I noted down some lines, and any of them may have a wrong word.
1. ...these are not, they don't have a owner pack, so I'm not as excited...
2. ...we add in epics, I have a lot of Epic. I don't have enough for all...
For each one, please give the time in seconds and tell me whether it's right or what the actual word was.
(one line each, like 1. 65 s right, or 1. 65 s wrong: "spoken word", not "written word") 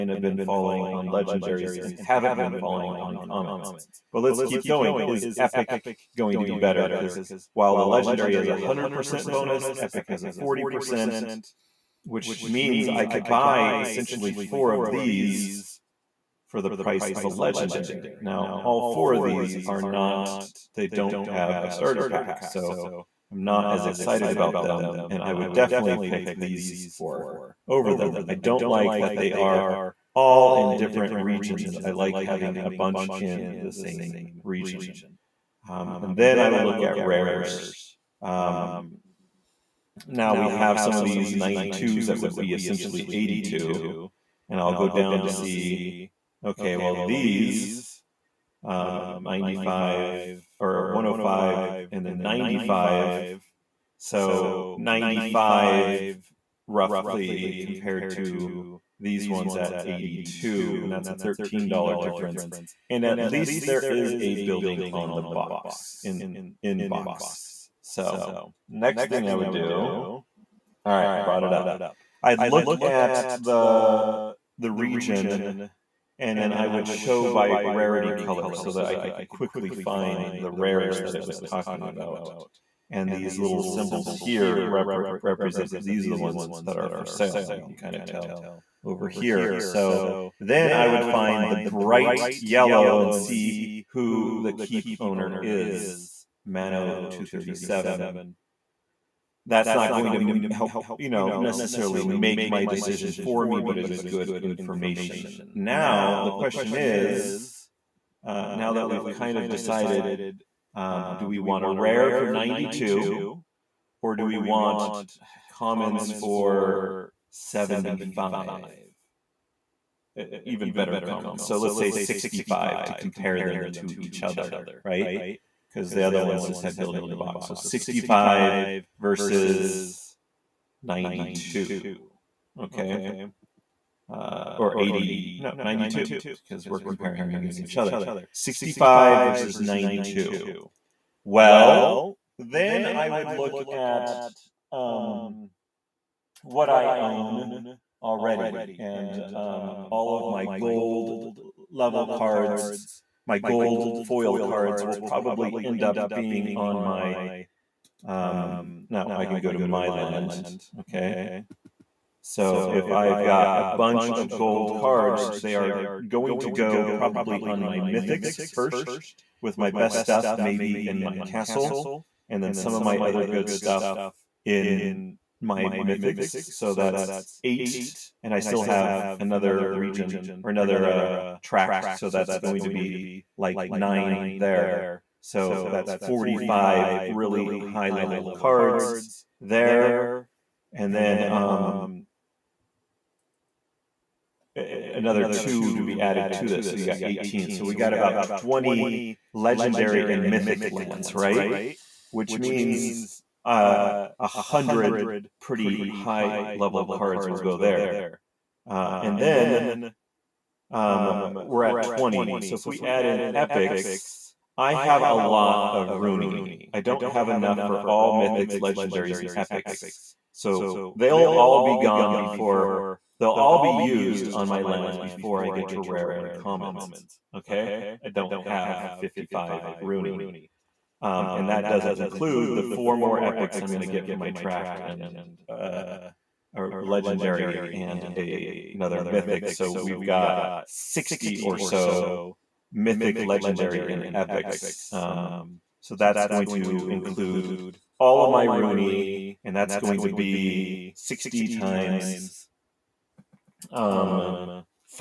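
1. 19 s wrong: "starter", not "owner"
2. 212 s wrong: "Runi", not "Epic".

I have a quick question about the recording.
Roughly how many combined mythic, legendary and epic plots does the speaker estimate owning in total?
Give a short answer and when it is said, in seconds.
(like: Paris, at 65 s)
60, at 240 s.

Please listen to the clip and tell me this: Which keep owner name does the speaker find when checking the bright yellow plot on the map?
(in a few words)
Mano 237.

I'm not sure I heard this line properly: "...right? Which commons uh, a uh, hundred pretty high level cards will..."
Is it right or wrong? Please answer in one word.
wrong.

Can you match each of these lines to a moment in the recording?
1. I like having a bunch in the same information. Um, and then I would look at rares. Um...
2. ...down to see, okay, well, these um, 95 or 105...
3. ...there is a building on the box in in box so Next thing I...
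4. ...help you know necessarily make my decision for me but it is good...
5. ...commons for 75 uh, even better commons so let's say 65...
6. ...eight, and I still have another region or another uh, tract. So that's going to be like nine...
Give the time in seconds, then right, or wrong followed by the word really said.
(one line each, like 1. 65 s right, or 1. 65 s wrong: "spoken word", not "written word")
1. 31 s wrong: "region", not "information"
2. 44 s right
3. 63 s right
4. 100 s right
5. 115 s right
6. 177 s right.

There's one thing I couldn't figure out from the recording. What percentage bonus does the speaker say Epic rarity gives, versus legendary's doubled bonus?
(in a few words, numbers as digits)
40%.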